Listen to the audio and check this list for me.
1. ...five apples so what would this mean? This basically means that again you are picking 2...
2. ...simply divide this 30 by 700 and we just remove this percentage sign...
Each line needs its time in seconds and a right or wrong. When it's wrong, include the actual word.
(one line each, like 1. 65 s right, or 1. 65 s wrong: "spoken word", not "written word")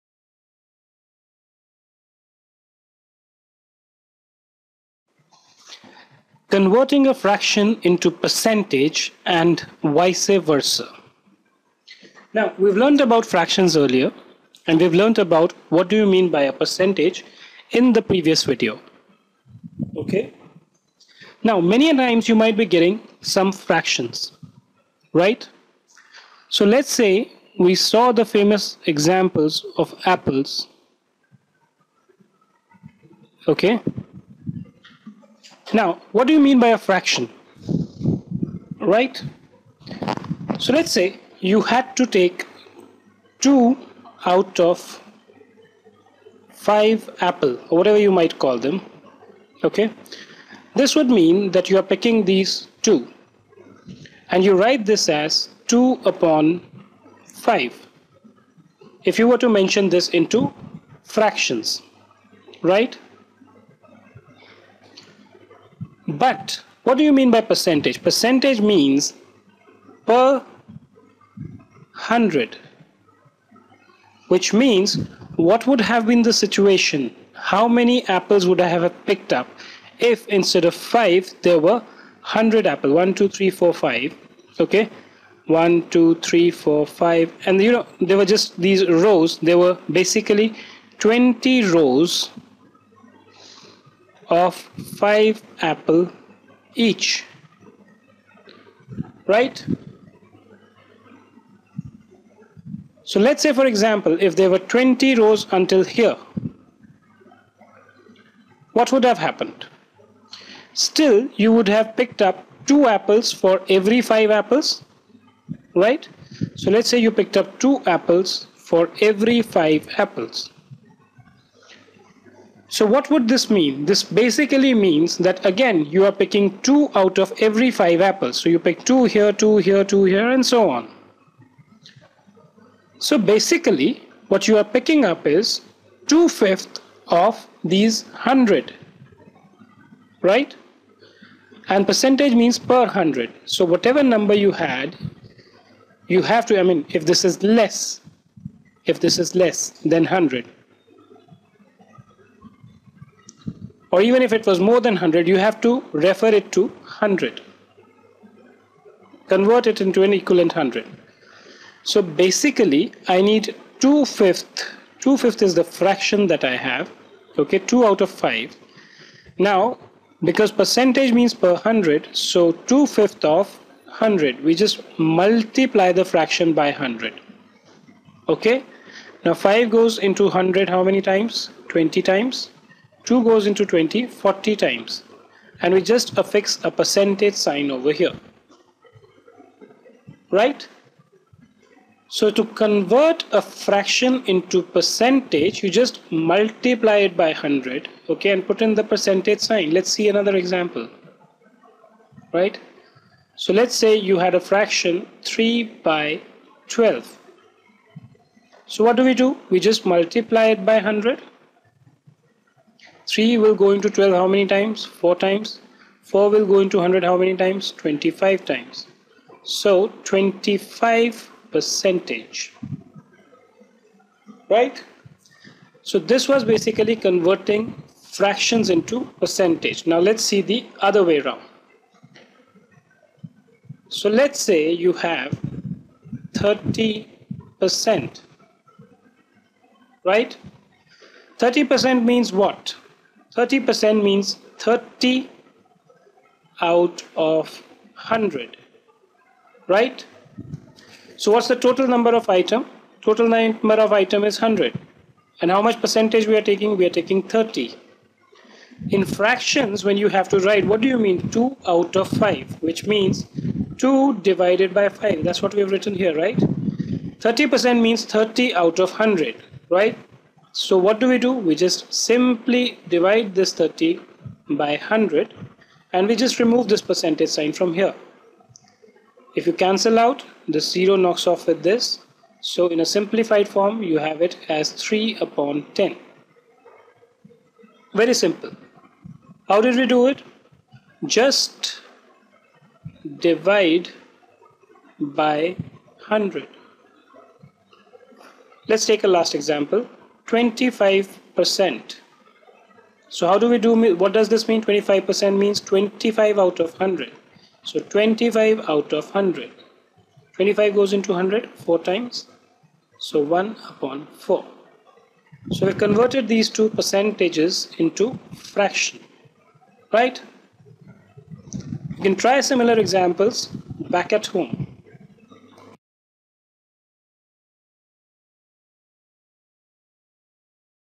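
1. 119 s right
2. 271 s wrong: "100", not "700".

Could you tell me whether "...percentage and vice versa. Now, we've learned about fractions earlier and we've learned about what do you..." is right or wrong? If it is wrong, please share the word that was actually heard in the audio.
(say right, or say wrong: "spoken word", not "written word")
right.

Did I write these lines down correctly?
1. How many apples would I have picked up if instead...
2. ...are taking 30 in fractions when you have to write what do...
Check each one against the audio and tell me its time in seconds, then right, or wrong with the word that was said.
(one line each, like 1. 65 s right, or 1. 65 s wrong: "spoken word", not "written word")
1. 77 s right
2. 256 s right.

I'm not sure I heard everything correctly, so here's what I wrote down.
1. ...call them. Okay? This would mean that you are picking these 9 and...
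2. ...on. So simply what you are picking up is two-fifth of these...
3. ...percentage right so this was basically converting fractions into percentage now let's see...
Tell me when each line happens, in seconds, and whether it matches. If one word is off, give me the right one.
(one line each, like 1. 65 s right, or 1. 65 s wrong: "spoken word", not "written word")
1. 48 s wrong: "2", not "9"
2. 130 s wrong: "basically", not "simply"
3. 221 s right.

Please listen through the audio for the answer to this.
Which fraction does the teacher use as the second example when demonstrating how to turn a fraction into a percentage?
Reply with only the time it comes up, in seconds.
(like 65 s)
205 s.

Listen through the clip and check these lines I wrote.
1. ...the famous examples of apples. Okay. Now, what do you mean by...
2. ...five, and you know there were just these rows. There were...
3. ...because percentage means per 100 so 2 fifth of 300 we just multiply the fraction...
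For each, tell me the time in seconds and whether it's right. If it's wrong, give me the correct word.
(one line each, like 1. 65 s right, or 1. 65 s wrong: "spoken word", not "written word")
1. 28 s right
2. 86 s right
3. 170 s wrong: "100", not "300".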